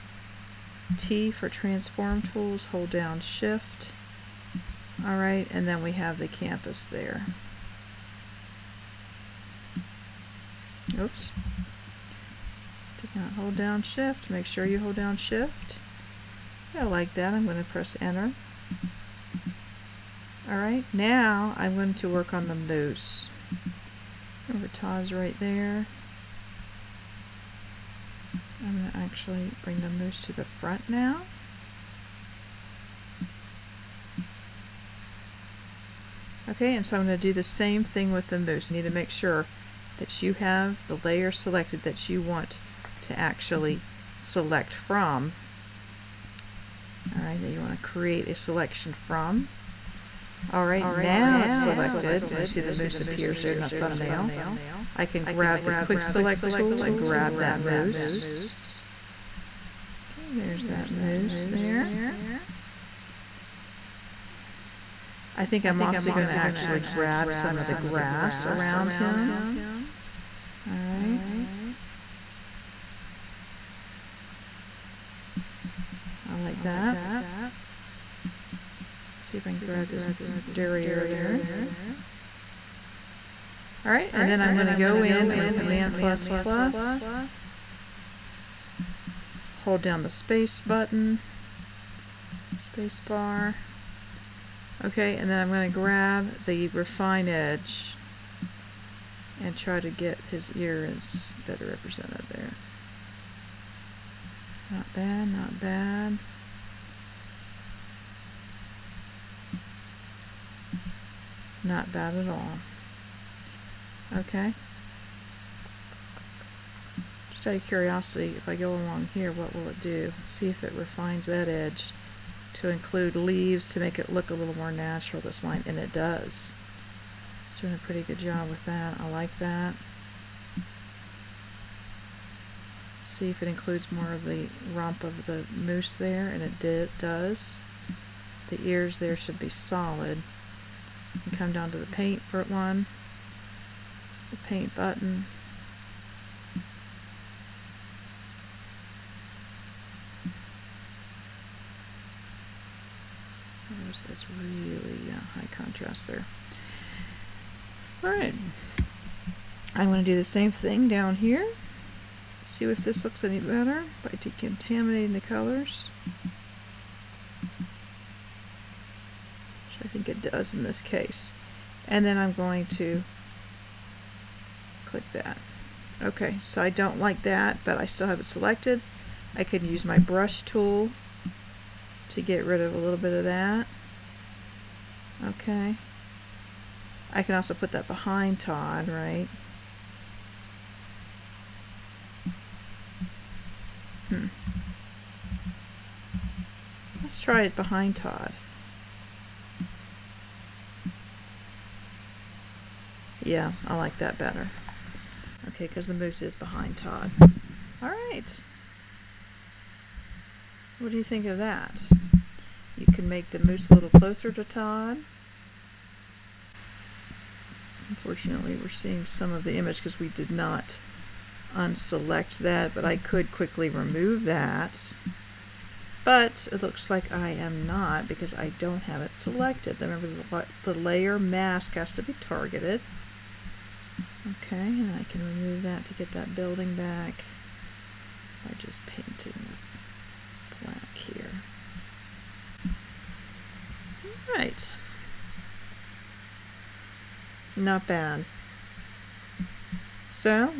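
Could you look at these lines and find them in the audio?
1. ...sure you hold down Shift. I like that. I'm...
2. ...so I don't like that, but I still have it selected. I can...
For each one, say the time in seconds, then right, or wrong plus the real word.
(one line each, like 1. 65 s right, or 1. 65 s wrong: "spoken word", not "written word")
1. 14 s right
2. 176 s right.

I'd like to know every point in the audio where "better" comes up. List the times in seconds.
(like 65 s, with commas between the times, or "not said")
101 s, 163 s, 204 s.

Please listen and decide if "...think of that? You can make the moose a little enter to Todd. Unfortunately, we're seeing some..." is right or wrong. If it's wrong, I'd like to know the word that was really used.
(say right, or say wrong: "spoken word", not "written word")
wrong: "closer", not "enter".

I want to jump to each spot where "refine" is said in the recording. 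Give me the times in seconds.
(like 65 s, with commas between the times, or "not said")
96 s, 120 s.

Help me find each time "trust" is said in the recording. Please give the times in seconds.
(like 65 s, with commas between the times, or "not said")
not said.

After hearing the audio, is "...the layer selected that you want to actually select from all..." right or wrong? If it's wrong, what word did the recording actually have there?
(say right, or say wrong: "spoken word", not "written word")
right.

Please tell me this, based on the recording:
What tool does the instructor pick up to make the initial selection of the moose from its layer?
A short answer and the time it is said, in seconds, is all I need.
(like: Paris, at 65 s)
quick select tool, at 55 s.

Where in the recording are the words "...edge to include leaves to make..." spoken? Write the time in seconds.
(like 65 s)
121 s.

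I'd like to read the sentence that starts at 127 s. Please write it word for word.
It's doing a pretty good job with that.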